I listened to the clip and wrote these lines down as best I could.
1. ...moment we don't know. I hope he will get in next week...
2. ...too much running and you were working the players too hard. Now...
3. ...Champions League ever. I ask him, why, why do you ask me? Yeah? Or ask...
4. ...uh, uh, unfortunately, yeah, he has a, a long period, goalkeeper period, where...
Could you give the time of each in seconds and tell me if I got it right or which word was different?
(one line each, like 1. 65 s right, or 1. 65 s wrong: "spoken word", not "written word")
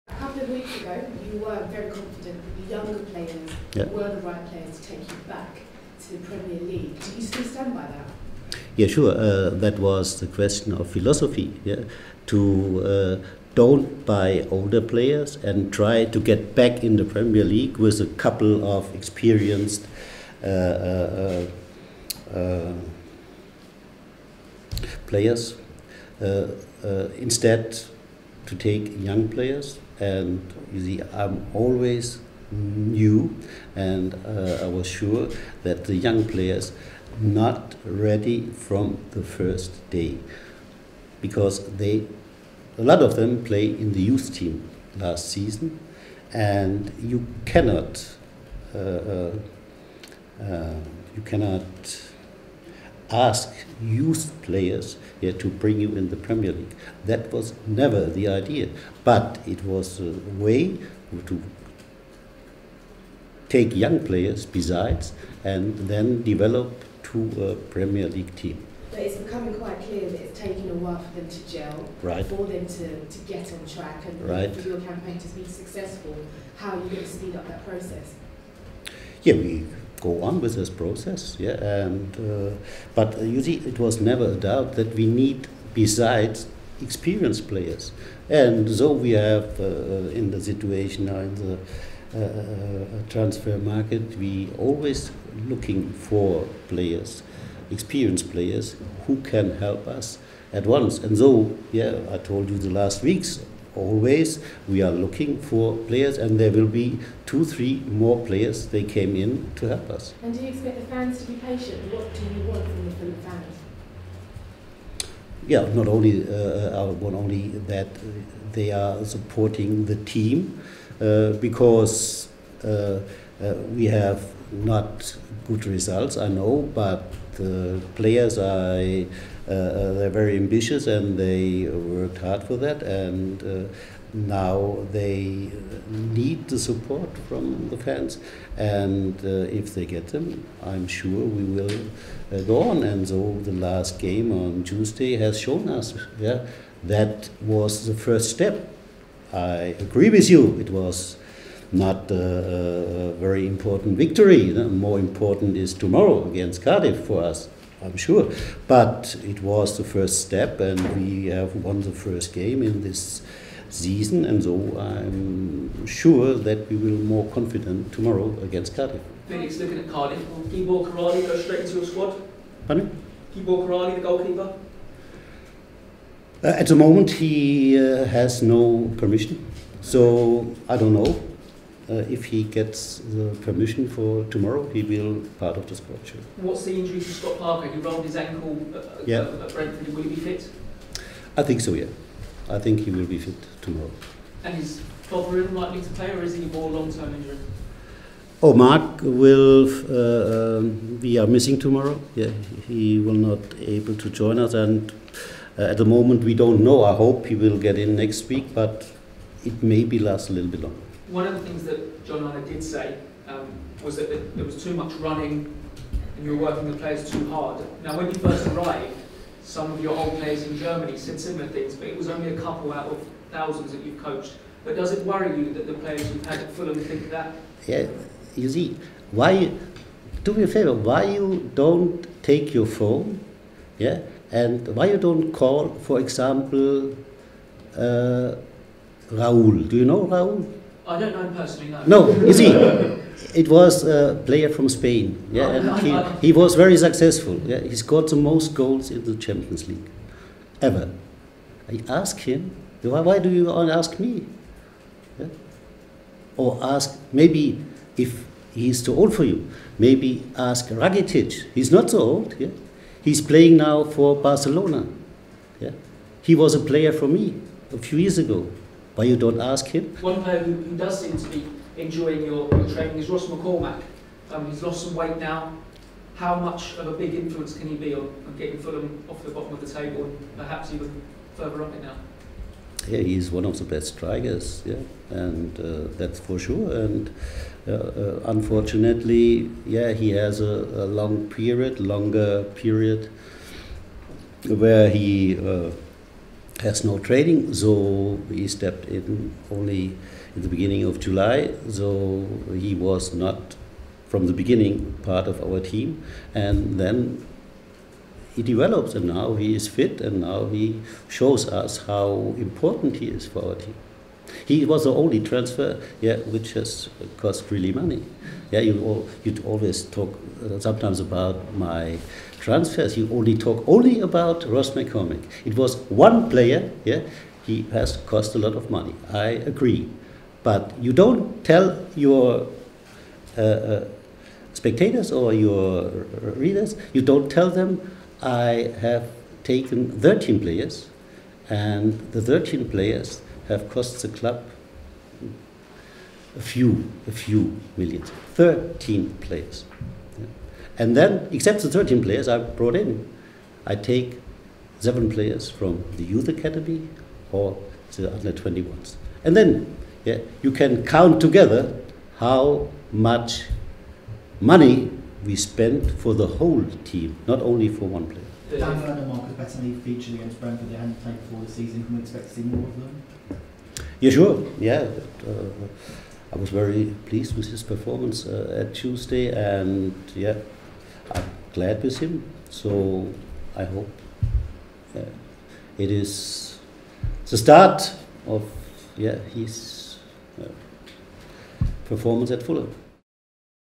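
1. 205 s right
2. 214 s right
3. 249 s right
4. 287 s wrong: "longer", not "goalkeeper".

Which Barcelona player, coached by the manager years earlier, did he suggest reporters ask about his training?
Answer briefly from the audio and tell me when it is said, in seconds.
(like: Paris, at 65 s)
Rakitic, at 260 s.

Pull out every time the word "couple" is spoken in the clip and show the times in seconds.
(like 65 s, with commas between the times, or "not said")
0 s, 18 s, 222 s.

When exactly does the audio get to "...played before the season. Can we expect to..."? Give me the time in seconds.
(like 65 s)
371 s.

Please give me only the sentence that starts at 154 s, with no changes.
More important is tomorrow against Cardiff for us, I'm sure.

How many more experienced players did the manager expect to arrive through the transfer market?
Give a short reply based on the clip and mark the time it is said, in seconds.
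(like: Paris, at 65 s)
2 or 3, at 107 s.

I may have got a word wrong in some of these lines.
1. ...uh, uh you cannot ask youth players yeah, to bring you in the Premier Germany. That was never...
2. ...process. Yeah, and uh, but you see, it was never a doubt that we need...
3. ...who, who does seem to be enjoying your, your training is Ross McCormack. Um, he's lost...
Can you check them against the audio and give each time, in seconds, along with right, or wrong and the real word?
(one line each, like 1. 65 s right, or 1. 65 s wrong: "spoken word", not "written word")
1. 48 s wrong: "League", not "Germany"
2. 80 s right
3. 270 s right.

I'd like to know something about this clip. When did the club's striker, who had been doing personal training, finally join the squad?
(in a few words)
Beginning of July.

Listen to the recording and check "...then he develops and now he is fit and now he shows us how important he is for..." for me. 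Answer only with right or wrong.
right.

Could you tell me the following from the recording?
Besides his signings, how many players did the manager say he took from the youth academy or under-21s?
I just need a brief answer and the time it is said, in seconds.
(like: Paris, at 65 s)
7, at 354 s.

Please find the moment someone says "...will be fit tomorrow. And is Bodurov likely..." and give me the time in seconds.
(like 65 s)
192 s.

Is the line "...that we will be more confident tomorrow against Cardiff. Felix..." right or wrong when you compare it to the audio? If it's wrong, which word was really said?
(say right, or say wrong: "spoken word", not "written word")
right.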